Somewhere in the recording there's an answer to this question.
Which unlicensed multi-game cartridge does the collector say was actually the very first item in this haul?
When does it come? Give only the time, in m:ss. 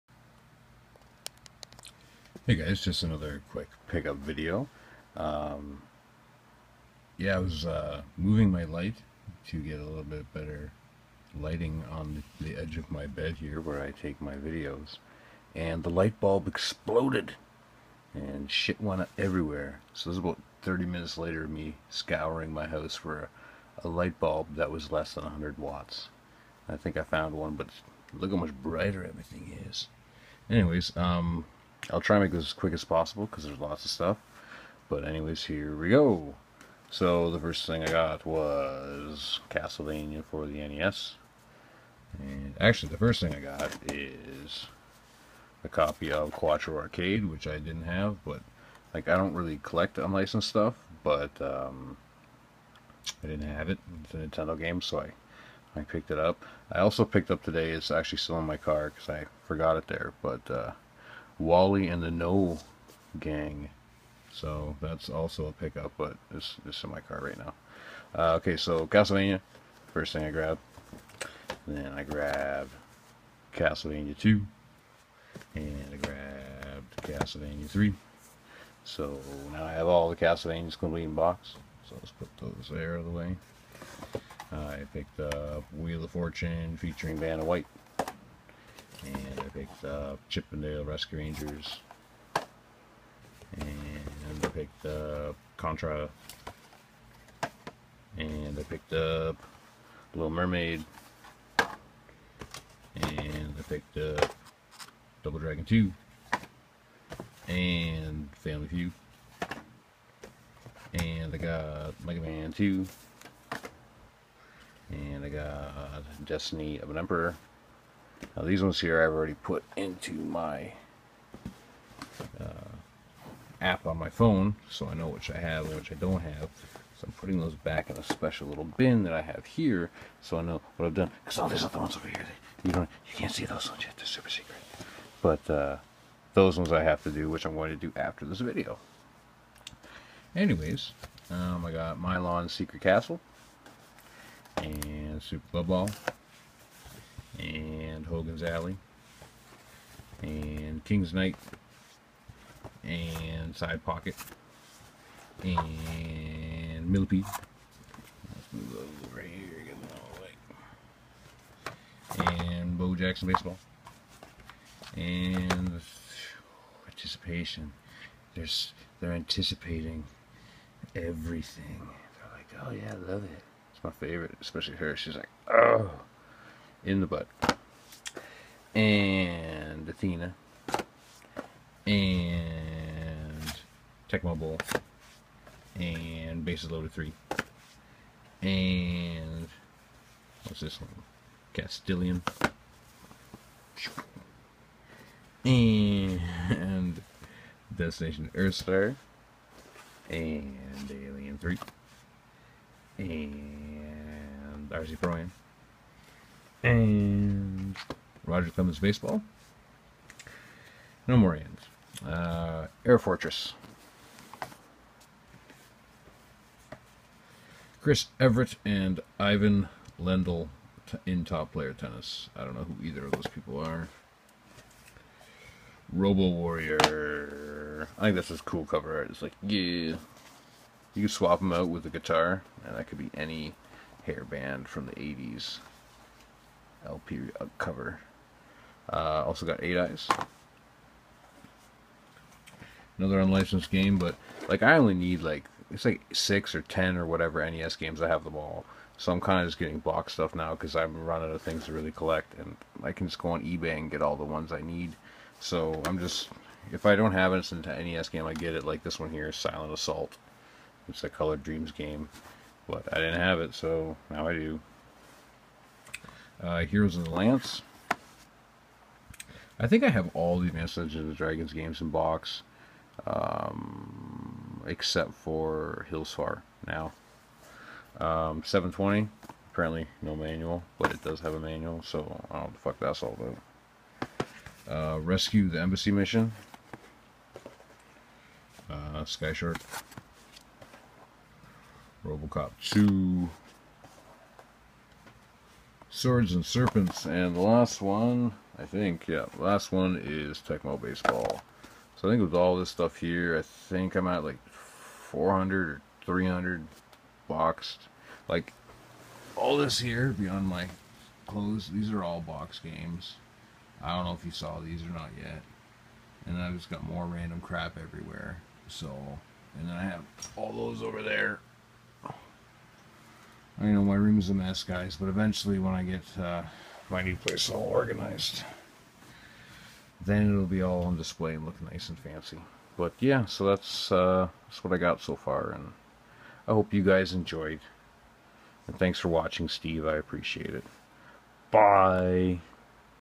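0:46.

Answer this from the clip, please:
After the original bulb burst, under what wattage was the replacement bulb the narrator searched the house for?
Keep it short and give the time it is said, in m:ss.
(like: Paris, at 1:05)
100 watts, at 0:25.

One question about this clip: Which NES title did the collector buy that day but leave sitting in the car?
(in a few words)
Wally and the No Gang.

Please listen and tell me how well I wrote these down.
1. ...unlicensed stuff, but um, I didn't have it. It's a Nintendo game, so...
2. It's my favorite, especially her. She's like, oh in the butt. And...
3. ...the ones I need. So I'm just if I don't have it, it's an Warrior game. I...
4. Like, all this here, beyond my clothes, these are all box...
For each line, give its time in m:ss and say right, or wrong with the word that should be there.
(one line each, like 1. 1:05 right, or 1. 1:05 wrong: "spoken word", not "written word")
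1. 0:49 right
2. 2:53 right
3. 4:14 wrong: "NES", not "Warrior"
4. 5:08 right.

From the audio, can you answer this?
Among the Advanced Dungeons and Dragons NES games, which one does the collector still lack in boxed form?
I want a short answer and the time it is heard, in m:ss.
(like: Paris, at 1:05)
Hillsfar, at 4:35.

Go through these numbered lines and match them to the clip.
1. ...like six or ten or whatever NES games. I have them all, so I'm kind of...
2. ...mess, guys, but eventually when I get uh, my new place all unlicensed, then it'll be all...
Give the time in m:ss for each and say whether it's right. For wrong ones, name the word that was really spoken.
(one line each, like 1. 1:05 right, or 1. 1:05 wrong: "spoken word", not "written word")
1. 4:05 right
2. 5:24 wrong: "organized", not "unlicensed".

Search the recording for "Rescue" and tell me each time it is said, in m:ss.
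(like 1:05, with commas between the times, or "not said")
1:30, 4:44.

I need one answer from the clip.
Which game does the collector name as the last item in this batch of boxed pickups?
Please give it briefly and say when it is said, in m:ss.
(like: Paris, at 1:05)
Tecmo Baseball, at 5:00.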